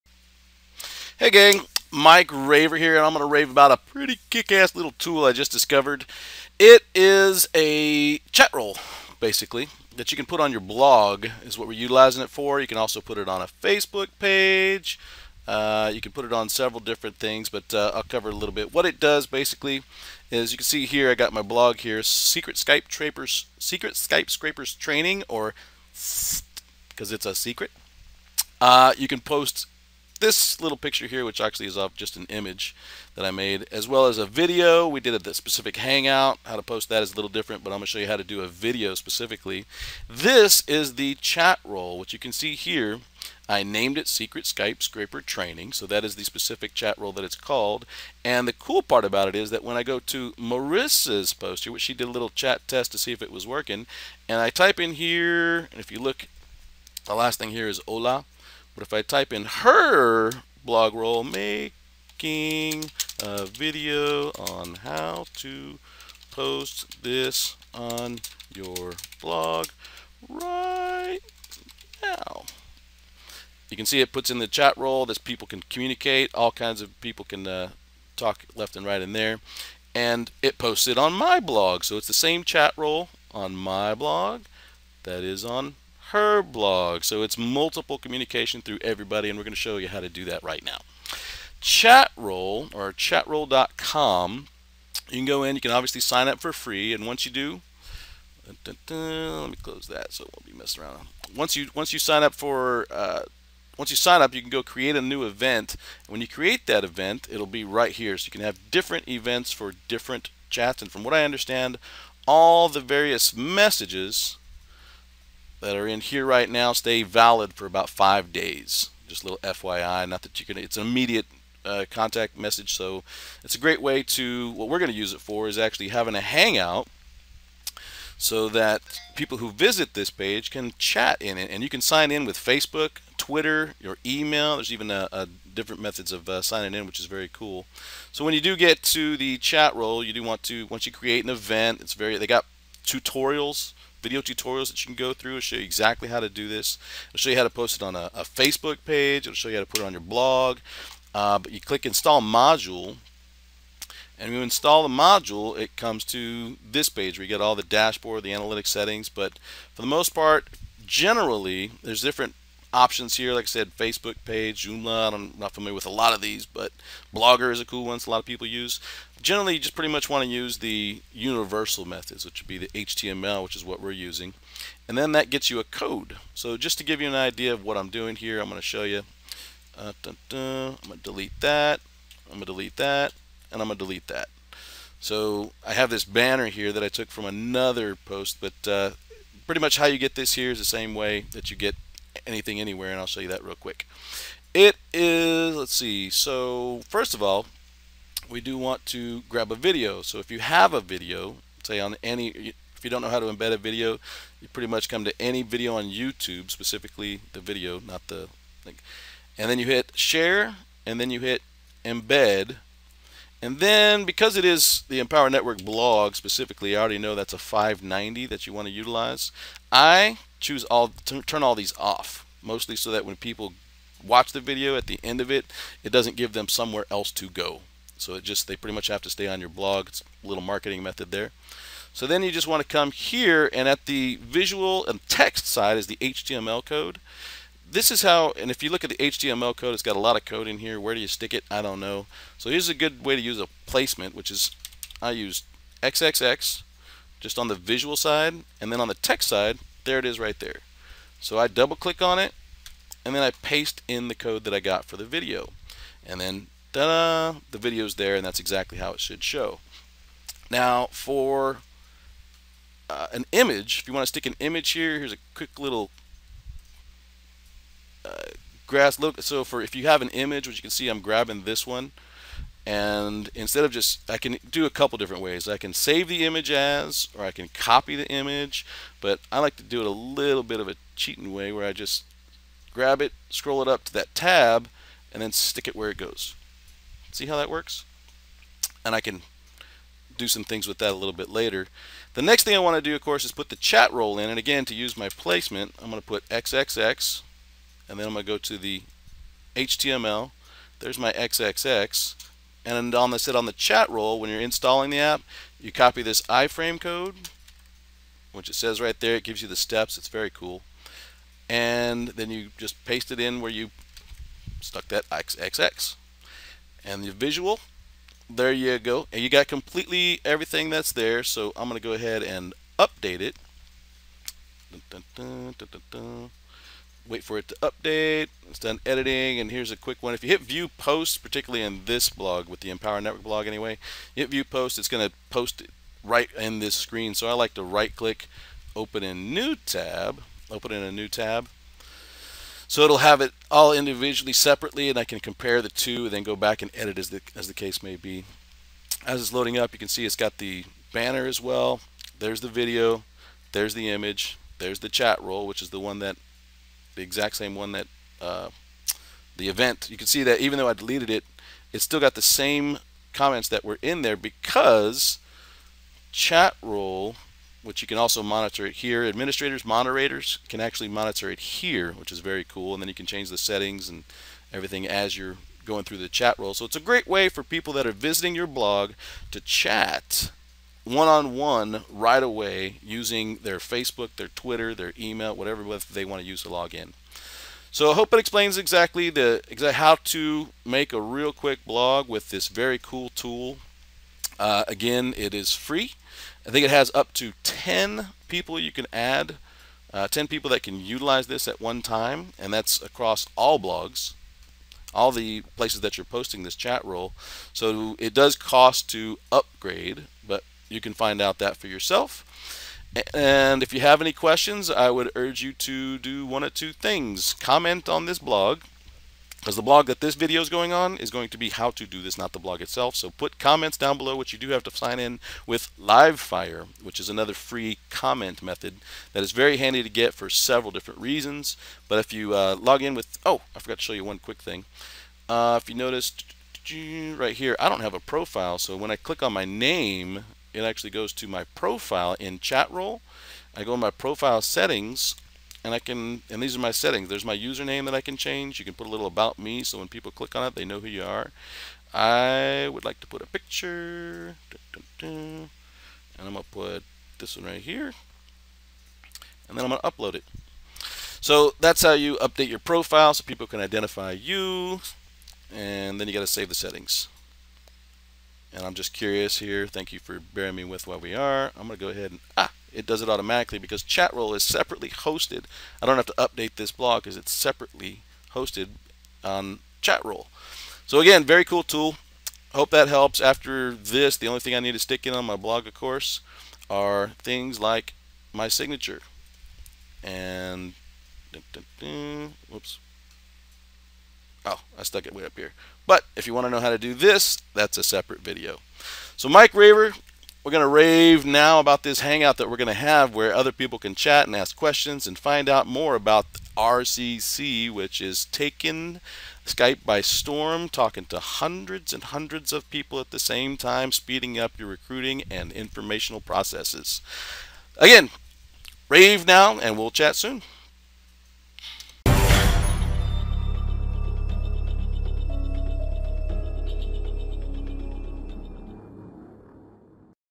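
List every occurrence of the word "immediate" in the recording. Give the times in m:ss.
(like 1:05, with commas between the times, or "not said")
2:00.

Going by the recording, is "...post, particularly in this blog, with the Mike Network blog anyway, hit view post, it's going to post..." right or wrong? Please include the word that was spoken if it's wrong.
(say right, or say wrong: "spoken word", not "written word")
wrong: "Empower", not "Mike".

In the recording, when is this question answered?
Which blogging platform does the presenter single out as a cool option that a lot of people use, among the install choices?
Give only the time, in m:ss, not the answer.
2:47.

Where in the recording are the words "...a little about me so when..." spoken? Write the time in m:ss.
7:28.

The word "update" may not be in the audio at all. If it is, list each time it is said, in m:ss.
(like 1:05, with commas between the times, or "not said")
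5:22, 5:27, 7:42, 7:56.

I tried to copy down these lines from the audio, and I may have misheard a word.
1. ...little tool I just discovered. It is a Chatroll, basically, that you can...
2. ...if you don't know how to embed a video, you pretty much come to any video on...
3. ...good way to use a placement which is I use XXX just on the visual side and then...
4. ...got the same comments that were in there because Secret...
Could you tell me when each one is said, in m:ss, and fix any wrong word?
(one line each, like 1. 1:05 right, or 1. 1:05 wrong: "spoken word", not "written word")
1. 0:04 right
2. 3:22 right
3. 4:02 right
4. 6:01 wrong: "Chatroll", not "Secret".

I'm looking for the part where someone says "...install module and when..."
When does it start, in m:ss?
2:31.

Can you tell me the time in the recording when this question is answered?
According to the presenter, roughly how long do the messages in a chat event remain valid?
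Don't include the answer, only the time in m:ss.
1:57.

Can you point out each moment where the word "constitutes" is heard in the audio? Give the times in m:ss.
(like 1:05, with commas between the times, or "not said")
not said.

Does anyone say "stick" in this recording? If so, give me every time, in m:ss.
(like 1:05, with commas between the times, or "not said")
4:01, 4:24, 4:45, 8:04.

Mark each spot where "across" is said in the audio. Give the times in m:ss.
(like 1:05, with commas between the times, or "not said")
6:42.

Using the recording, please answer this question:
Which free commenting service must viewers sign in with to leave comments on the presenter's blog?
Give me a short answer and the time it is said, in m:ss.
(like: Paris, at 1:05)
Livefyre, at 7:05.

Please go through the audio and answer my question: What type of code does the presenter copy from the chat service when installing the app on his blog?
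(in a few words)
iframe code.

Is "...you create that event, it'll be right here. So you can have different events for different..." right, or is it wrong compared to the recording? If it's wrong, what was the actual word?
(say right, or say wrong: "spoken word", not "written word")
right.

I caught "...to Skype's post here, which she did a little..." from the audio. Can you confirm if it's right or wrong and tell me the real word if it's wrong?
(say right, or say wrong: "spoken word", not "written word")
wrong: "Marissa", not "Skype".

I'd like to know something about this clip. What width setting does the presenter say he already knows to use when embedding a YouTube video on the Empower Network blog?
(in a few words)
590.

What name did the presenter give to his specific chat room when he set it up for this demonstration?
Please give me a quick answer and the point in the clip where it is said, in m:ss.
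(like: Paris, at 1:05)
Secret Skype Scraper Training, at 0:44.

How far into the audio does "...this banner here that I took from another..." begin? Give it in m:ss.
3:05.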